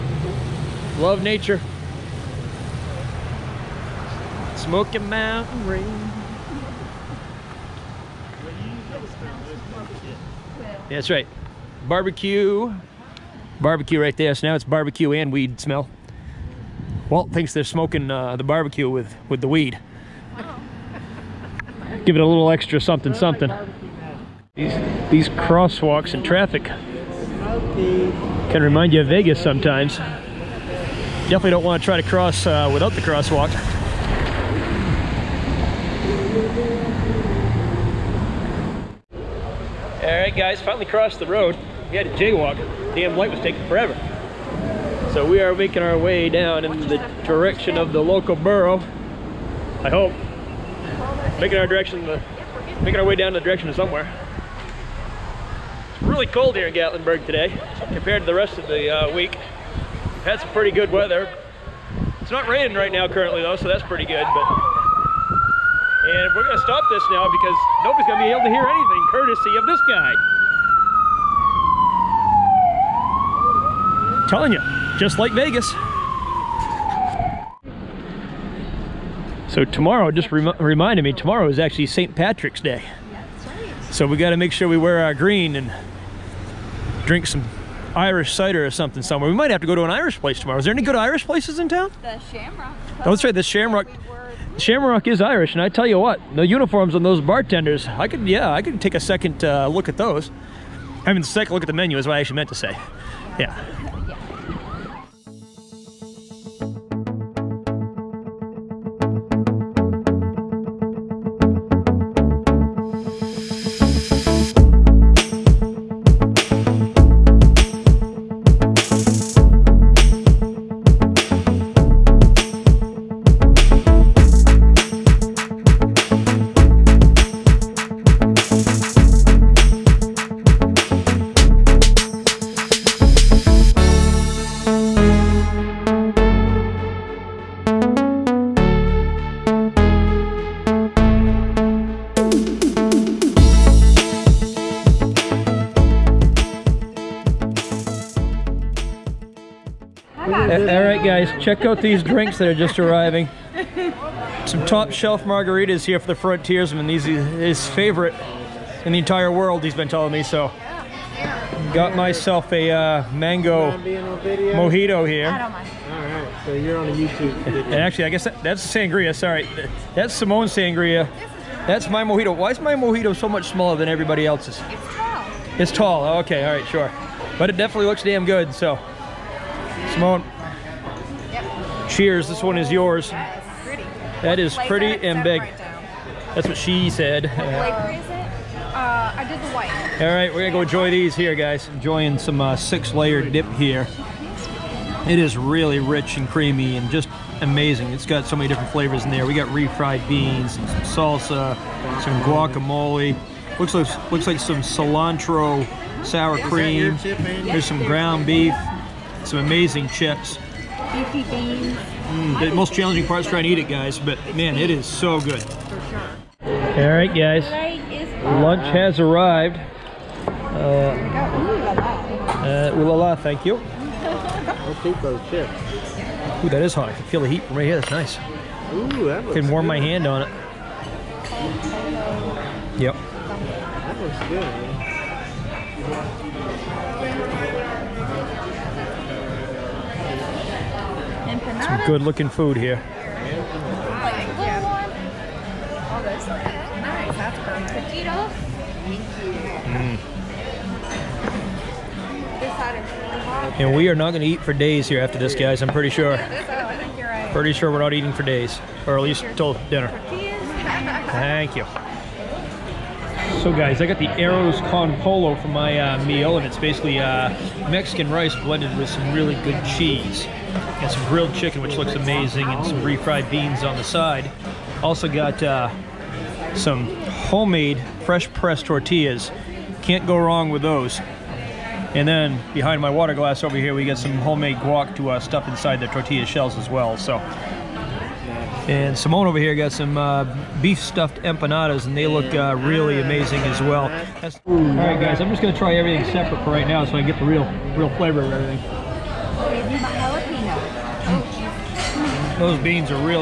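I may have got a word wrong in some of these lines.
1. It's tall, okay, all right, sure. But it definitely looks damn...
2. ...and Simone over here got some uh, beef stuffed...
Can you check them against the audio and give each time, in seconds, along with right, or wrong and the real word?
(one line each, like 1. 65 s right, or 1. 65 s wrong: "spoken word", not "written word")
1. 175 s right
2. 288 s right.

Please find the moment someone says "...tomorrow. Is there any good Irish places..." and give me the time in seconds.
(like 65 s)
90 s.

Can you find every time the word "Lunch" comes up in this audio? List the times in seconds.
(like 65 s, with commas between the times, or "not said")
218 s.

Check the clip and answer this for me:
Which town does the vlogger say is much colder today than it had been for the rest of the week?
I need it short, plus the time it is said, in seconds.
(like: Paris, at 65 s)
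Gatlinburg, at 56 s.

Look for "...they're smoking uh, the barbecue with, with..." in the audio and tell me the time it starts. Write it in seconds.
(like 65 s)
17 s.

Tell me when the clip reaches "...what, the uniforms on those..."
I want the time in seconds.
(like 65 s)
95 s.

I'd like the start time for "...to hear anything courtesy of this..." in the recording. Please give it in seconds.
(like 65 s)
68 s.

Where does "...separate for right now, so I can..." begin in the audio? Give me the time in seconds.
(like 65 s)
296 s.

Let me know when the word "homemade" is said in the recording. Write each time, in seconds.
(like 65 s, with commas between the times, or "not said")
277 s, 284 s.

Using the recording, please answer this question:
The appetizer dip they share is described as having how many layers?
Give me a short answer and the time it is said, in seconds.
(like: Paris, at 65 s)
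6, at 192 s.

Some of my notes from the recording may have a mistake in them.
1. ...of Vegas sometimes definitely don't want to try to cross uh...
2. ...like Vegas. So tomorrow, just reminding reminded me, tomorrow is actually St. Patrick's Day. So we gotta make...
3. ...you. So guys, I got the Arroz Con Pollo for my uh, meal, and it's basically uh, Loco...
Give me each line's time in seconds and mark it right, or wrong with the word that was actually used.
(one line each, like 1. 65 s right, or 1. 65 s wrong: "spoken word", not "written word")
1. 29 s right
2. 75 s right
3. 261 s wrong: "Mexican", not "Loco".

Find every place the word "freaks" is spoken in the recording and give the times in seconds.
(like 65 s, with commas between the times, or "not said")
not said.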